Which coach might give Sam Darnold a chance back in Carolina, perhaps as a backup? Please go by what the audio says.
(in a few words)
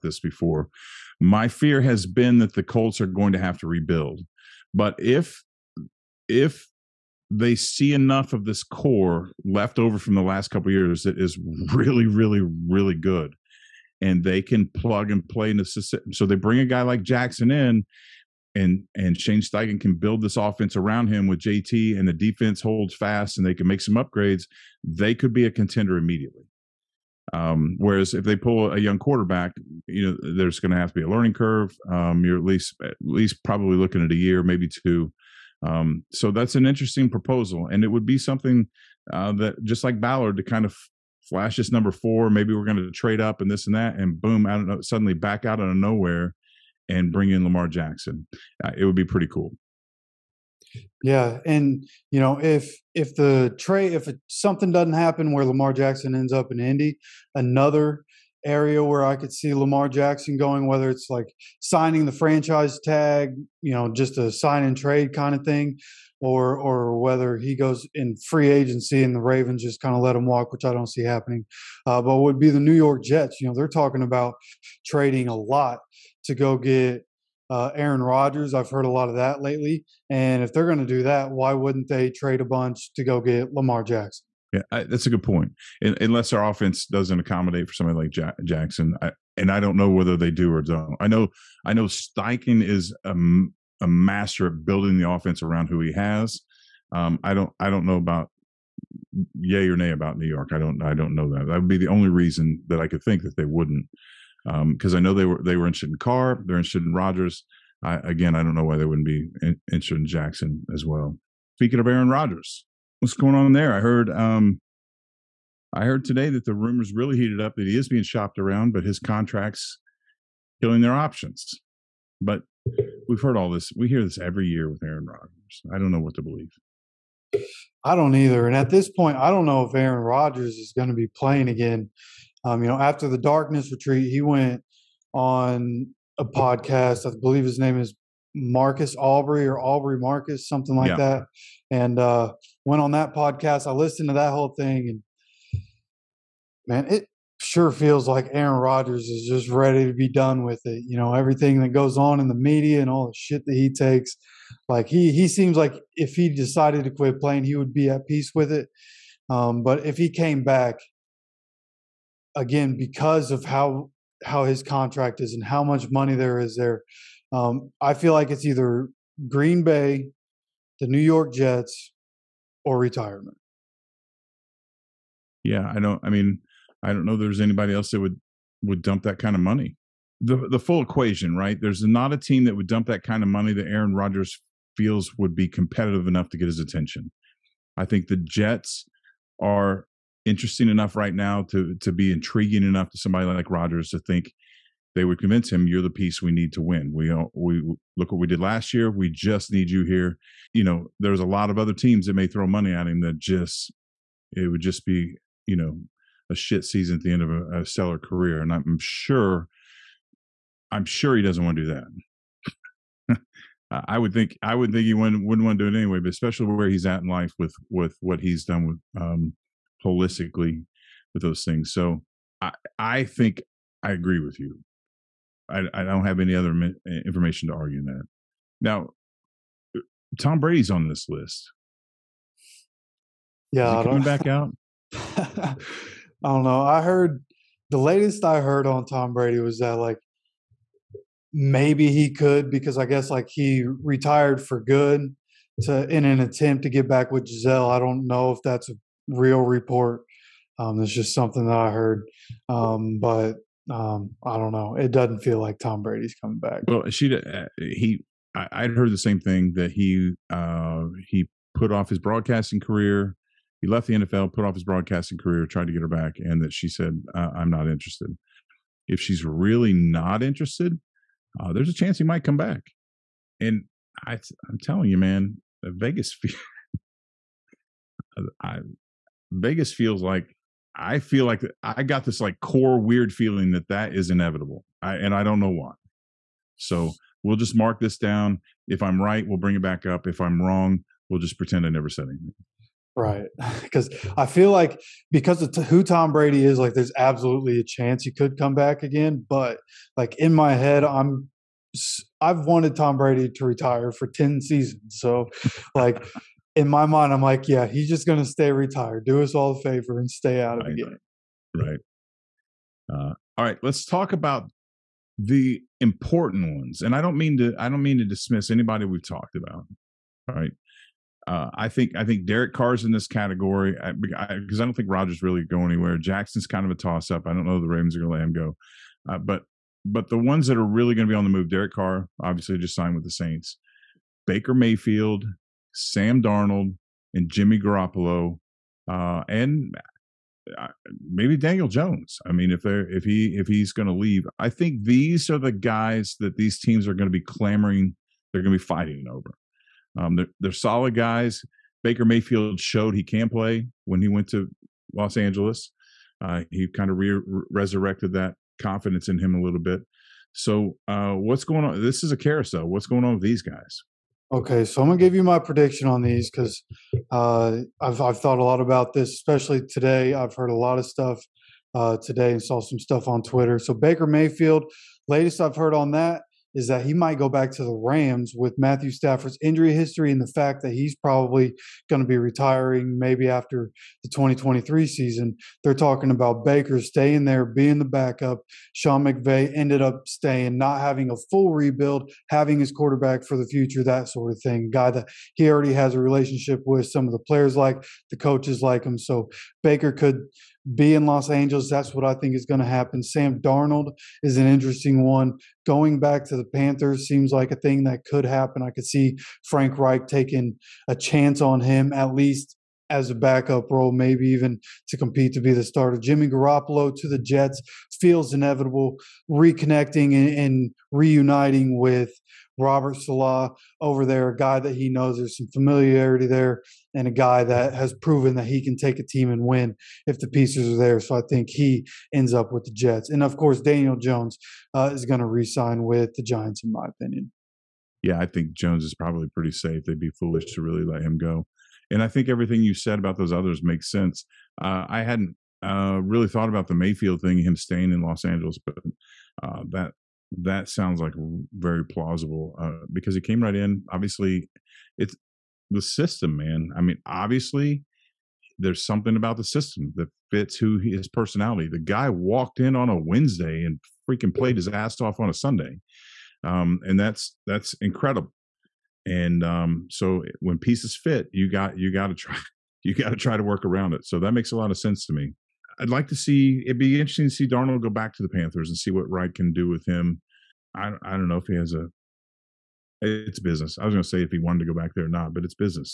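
Frank Reich.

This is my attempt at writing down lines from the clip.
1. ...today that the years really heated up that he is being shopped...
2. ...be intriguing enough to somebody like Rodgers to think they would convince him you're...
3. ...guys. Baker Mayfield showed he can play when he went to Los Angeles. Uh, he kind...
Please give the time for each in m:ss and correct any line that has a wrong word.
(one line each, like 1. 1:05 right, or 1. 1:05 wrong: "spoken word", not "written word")
1. 1:56 wrong: "rumors", not "years"
2. 3:11 right
3. 5:50 right.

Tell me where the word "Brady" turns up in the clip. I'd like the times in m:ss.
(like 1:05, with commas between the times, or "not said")
3:50, 3:59, 4:15, 4:56, 5:02.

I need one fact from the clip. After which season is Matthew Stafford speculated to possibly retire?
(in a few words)
2023.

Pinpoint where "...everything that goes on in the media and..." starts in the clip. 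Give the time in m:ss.
2:31.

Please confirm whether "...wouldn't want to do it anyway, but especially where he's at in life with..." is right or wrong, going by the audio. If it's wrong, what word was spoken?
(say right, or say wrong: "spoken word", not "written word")
right.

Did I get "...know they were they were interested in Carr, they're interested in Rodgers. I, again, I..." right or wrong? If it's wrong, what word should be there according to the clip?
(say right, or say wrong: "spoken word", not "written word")
right.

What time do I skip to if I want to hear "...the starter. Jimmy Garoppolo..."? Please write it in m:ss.
6:55.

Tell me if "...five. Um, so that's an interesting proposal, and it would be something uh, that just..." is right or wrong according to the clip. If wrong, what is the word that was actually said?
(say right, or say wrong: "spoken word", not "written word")
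wrong: "two", not "five".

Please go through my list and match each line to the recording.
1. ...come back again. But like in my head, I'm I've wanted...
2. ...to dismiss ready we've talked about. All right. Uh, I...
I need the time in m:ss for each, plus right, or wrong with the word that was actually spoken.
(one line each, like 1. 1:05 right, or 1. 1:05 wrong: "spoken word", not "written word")
1. 4:58 right
2. 5:17 wrong: "anybody", not "ready".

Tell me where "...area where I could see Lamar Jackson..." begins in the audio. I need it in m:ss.
0:58.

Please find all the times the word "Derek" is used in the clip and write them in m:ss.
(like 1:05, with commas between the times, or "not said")
5:22, 5:31.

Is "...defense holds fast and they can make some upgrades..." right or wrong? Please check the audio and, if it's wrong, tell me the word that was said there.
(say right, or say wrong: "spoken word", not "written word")
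right.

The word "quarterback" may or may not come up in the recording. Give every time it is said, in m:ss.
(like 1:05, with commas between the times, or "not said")
0:28, 6:32.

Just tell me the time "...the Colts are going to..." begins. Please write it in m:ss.
0:02.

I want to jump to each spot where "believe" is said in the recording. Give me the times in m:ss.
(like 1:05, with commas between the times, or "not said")
2:06, 2:17.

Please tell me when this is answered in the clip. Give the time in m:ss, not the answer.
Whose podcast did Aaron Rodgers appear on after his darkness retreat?
2:19.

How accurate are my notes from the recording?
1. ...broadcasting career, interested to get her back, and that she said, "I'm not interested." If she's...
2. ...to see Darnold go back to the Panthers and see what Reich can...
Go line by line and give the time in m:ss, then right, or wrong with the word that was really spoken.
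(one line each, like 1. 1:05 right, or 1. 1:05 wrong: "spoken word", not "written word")
1. 4:24 wrong: "tried", not "interested"
2. 7:57 right.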